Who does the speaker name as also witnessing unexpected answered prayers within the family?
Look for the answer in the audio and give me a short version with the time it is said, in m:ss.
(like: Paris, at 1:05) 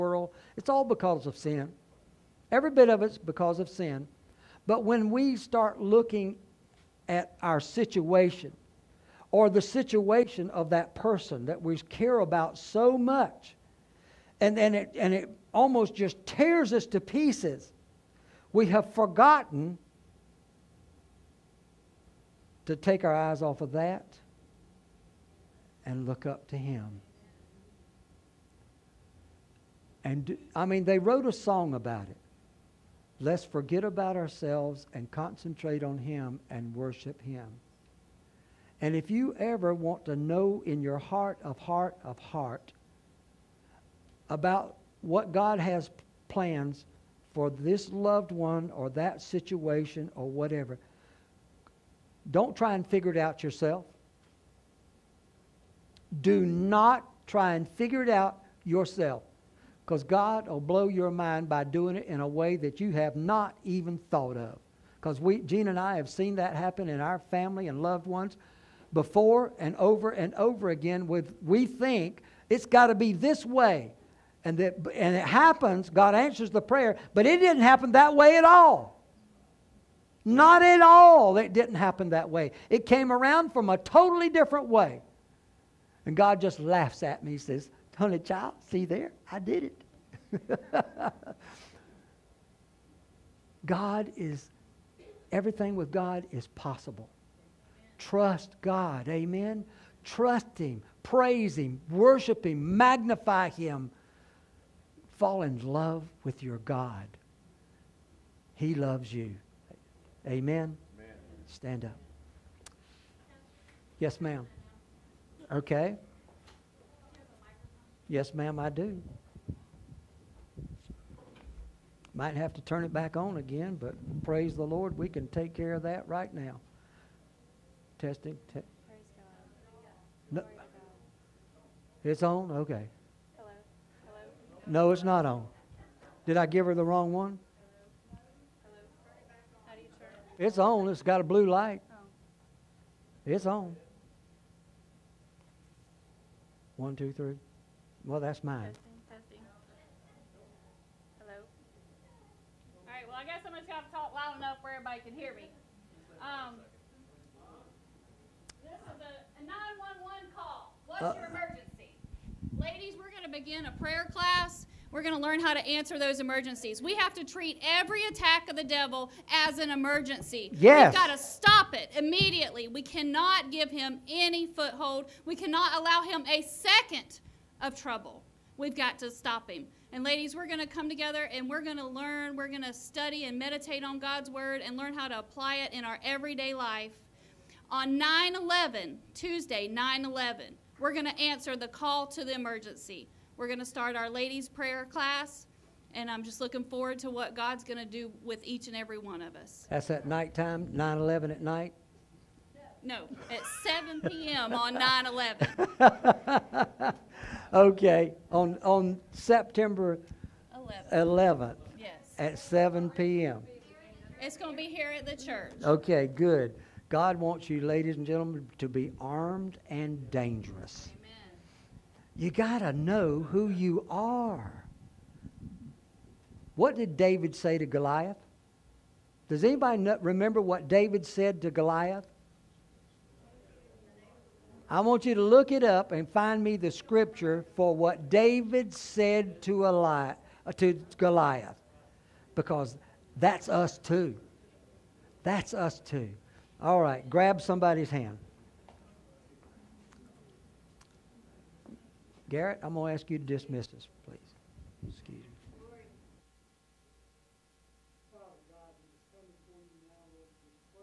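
Gene, at 1:05.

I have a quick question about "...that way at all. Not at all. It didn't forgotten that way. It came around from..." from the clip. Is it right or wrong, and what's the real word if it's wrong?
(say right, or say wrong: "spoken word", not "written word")
wrong: "happen", not "forgotten".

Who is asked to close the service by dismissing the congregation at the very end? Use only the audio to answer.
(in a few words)
Garrett.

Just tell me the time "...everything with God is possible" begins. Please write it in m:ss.
1:35.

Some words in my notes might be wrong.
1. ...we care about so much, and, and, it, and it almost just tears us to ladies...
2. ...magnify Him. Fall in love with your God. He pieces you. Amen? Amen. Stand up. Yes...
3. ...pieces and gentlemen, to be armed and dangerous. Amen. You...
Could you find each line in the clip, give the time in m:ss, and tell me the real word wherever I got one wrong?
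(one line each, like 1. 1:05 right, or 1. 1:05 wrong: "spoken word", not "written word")
1. 0:11 wrong: "pieces", not "ladies"
2. 1:42 wrong: "loves", not "pieces"
3. 3:37 wrong: "ladies", not "pieces".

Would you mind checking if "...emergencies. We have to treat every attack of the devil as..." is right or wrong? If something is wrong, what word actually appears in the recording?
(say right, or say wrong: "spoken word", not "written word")
right.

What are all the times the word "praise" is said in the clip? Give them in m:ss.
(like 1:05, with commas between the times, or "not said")
1:41, 2:04.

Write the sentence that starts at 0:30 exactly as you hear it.
And I mean, they wrote a song about it.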